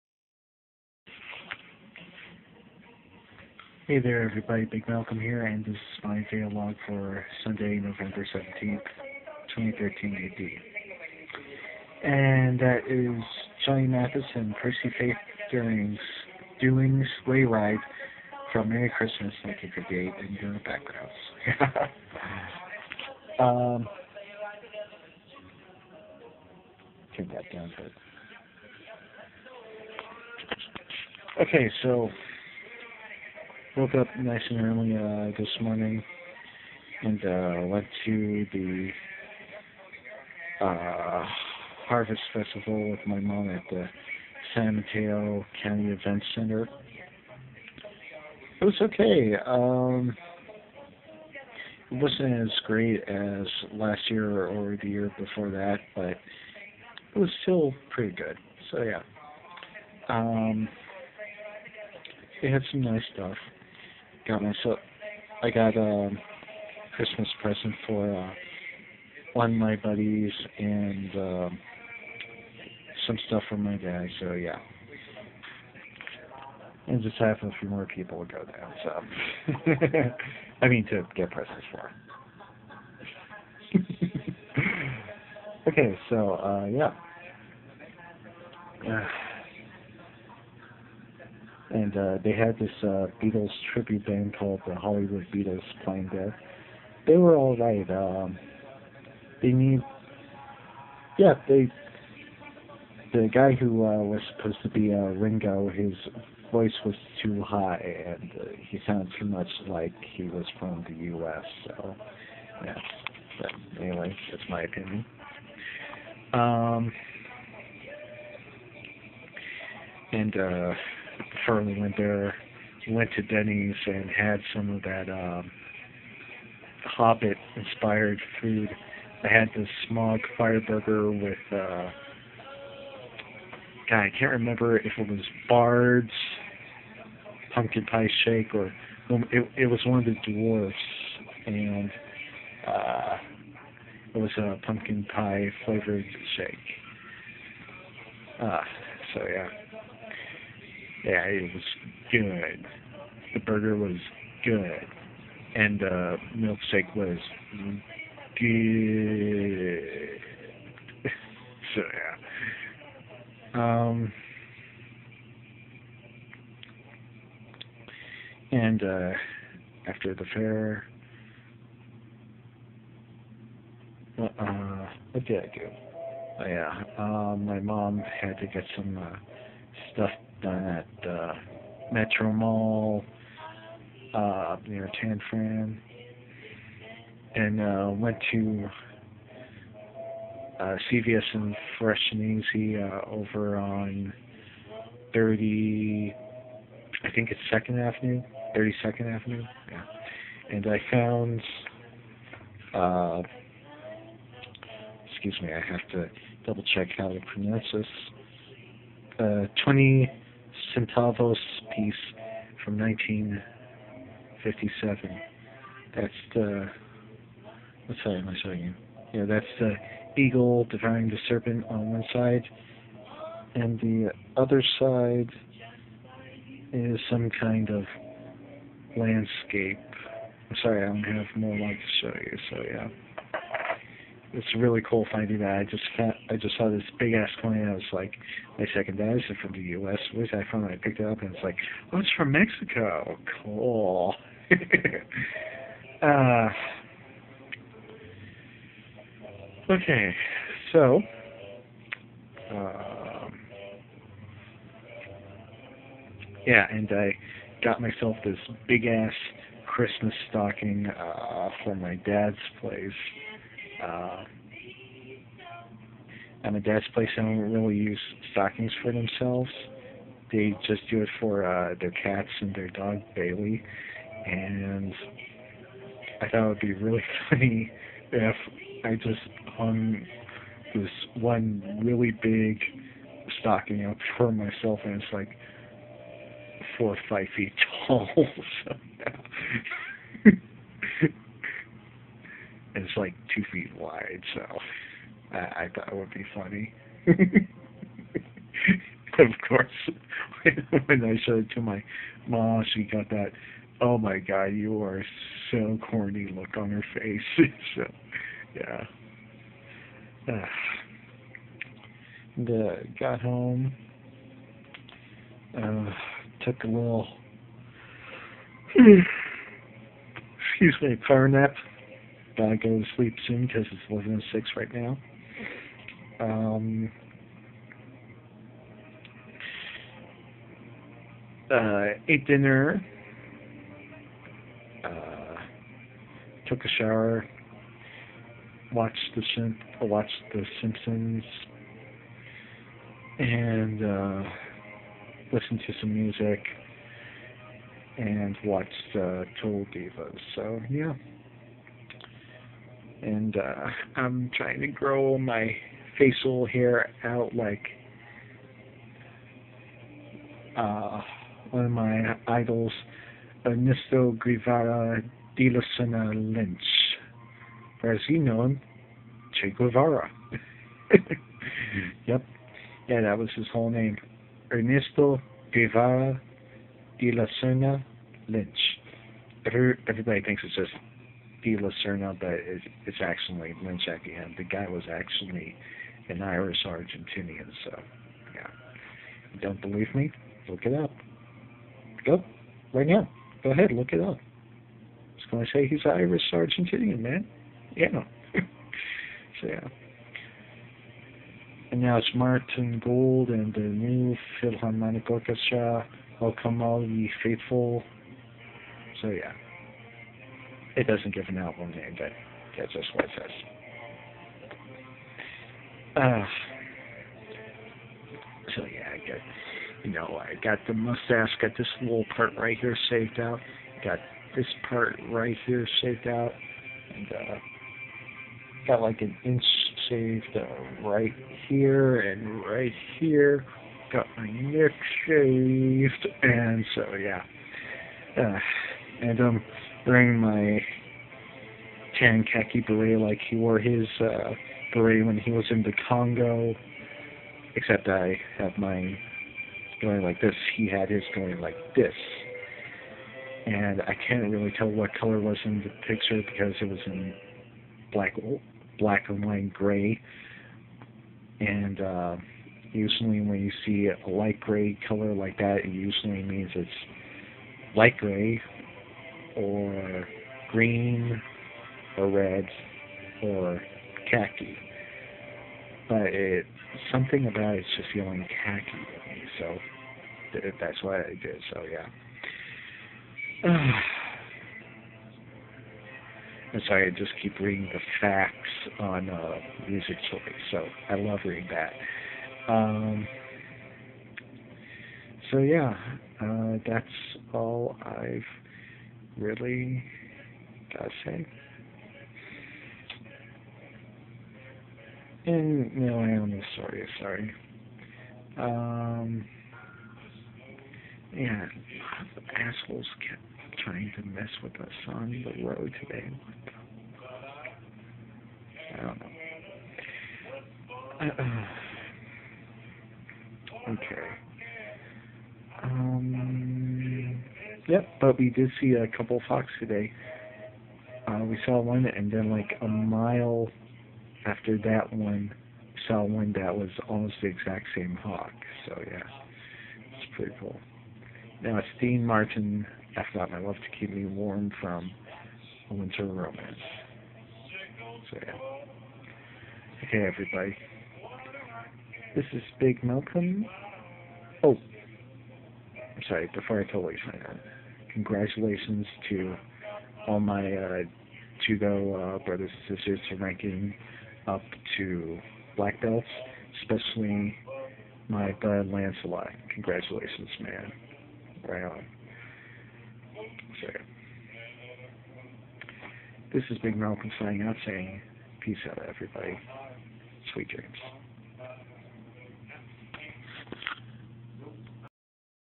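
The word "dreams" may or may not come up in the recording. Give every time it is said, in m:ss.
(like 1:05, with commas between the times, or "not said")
9:40.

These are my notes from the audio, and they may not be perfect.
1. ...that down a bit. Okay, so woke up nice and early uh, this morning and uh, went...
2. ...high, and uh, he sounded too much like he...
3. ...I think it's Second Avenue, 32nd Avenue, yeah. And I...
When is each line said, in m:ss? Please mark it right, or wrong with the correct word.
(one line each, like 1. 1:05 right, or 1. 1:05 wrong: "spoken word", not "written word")
1. 0:27 right
2. 1:47 right
3. 3:17 right.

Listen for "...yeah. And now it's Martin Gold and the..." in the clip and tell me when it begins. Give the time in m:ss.
6:39.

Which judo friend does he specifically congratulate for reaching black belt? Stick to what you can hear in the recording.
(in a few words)
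Lancelot.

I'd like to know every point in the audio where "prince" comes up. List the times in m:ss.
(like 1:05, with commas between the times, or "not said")
not said.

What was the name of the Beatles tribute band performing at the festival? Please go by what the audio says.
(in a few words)
Hollywood Beatles.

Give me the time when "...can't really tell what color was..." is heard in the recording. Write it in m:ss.
7:34.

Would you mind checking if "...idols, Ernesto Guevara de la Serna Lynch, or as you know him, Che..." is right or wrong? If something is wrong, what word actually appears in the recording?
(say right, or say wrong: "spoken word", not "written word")
right.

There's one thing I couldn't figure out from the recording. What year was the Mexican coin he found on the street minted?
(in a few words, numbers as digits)
1957.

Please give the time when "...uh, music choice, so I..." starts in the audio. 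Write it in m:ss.
8:09.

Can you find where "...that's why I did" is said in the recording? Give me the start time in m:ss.
8:00.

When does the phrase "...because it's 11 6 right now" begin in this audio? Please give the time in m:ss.
5:23.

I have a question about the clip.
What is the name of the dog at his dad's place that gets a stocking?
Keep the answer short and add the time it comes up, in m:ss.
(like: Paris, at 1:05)
Bailey, at 4:33.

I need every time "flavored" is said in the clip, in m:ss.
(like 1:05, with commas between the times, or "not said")
2:25.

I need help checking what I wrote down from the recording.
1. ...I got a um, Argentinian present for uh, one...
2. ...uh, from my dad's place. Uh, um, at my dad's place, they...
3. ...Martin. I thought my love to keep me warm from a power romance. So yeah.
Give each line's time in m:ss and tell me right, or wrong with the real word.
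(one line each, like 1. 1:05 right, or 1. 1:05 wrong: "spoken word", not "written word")
1. 1:05 wrong: "Christmas", not "Argentinian"
2. 4:20 right
3. 9:02 wrong: "winter", not "power".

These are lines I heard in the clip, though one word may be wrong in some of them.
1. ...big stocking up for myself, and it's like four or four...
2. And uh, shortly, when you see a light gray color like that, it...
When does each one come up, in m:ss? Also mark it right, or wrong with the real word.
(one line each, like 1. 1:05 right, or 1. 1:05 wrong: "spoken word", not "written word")
1. 4:42 wrong: "five", not "four"
2. 7:41 wrong: "usually", not "shortly".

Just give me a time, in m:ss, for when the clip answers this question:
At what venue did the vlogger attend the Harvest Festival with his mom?
0:44.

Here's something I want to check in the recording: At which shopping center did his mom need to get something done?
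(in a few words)
Metro Mall.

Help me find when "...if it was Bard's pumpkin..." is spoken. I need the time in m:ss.
2:14.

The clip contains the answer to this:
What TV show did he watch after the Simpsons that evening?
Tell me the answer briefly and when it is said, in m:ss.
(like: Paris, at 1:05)
Total Divas, at 5:49.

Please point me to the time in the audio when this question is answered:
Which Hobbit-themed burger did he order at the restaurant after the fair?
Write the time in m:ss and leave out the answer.
2:09.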